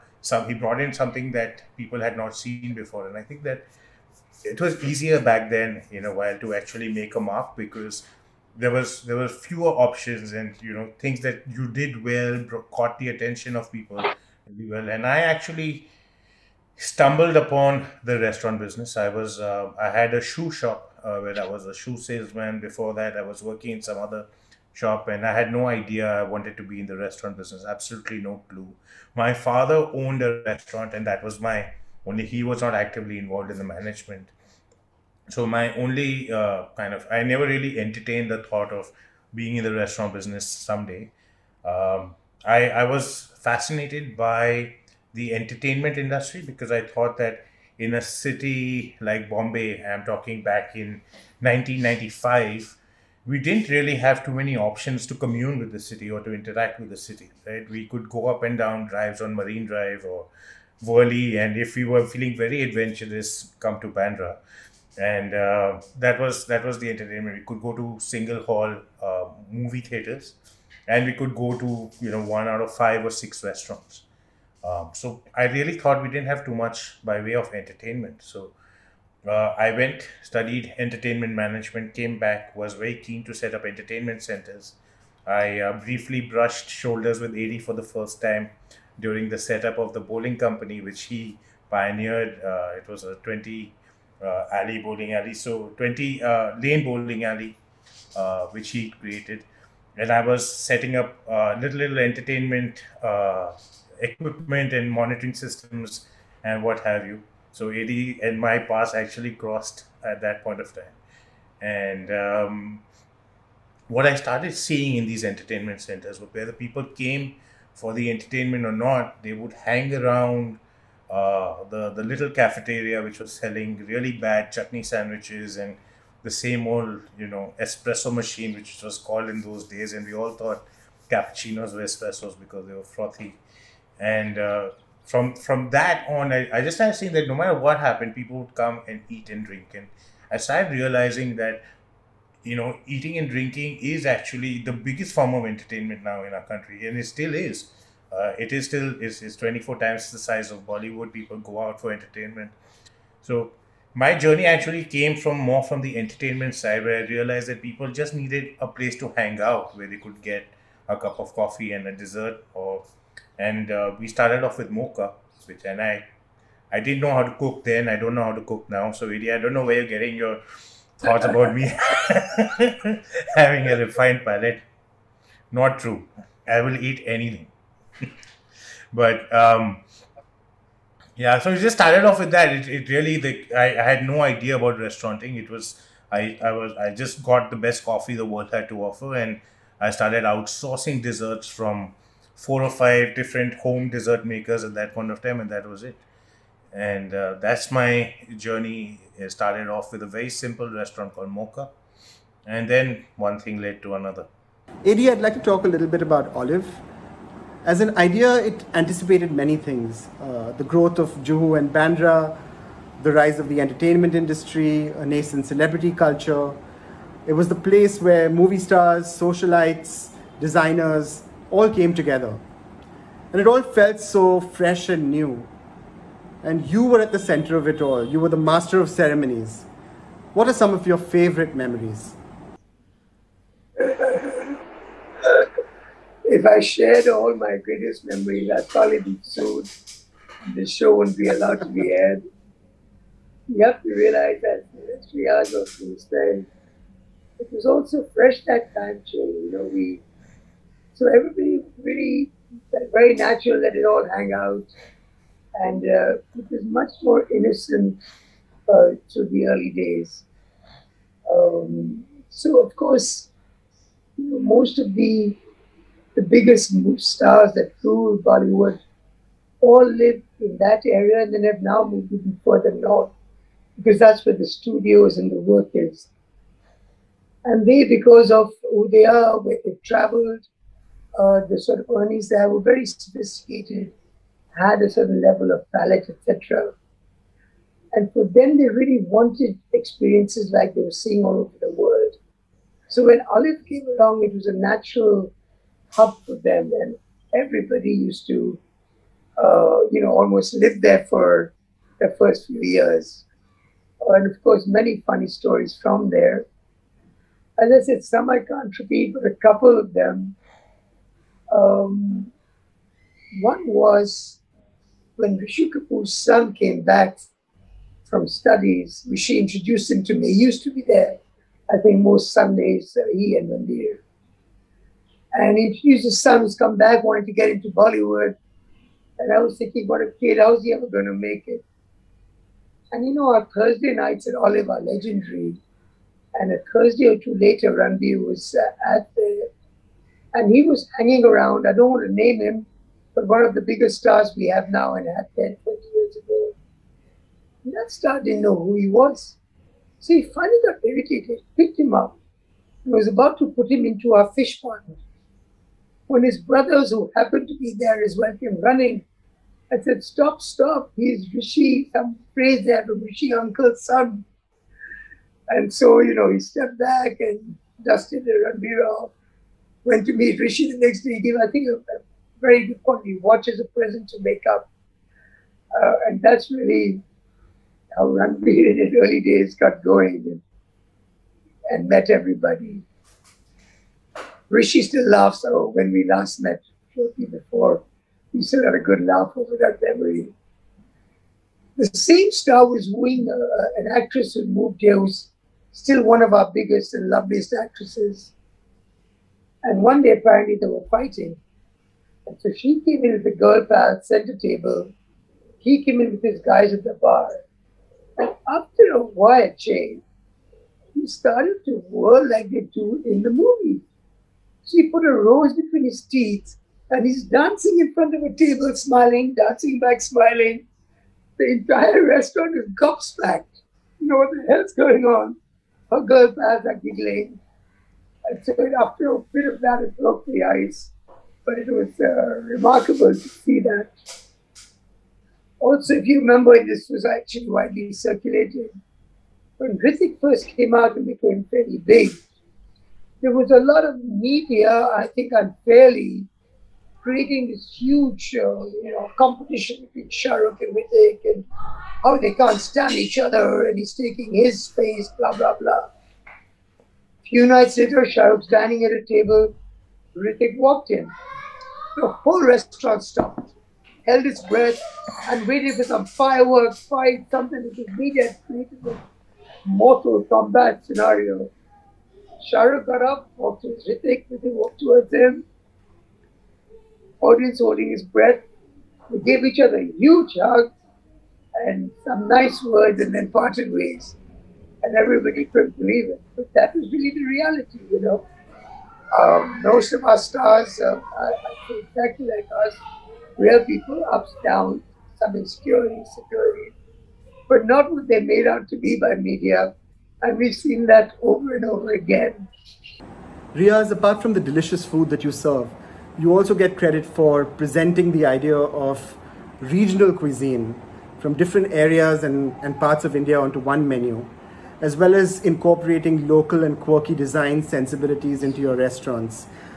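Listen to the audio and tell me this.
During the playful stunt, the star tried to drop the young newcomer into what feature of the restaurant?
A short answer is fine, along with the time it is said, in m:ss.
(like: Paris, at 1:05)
fish pond, at 5:54.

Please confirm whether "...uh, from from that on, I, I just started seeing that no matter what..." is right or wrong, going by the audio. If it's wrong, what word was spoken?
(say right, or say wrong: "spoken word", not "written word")
right.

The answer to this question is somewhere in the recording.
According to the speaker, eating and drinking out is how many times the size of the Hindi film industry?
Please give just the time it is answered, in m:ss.
2:29.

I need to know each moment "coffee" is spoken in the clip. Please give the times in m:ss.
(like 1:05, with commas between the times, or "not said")
2:41, 3:07.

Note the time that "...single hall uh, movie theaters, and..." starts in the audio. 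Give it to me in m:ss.
1:07.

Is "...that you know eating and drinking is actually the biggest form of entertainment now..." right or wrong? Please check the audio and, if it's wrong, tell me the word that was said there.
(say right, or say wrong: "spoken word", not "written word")
right.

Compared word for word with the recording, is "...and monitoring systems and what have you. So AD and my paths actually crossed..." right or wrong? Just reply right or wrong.
right.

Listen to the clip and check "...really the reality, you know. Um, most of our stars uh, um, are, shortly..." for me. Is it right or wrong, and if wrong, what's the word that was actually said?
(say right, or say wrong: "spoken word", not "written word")
wrong: "exactly", not "shortly".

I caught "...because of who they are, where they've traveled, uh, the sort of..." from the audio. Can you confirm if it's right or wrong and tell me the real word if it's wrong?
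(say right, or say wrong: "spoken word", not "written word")
right.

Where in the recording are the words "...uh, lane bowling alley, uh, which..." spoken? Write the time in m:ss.
1:36.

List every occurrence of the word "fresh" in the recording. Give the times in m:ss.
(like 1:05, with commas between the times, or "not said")
3:44, 4:08.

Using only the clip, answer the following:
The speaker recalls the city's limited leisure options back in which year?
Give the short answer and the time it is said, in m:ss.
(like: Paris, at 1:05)
1995, at 0:51.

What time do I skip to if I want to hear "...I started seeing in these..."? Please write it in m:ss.
1:54.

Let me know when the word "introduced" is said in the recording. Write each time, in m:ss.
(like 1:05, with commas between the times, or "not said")
5:19, 5:25.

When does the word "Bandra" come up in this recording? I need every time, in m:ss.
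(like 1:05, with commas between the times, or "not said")
1:03, 3:31.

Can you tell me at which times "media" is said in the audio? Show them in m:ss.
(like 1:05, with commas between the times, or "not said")
7:24, 8:19.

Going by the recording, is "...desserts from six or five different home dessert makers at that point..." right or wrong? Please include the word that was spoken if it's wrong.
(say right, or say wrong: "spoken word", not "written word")
wrong: "four", not "six".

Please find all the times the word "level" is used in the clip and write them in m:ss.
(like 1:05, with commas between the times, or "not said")
4:45.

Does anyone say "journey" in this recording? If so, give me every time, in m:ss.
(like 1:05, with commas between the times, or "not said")
2:34, 3:18.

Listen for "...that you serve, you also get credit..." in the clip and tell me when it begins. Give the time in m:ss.
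8:25.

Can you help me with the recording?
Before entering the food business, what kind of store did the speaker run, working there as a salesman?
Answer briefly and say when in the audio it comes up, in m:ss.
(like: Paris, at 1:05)
shoe shop, at 0:20.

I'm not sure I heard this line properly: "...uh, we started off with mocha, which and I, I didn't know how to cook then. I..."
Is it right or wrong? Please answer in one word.
right.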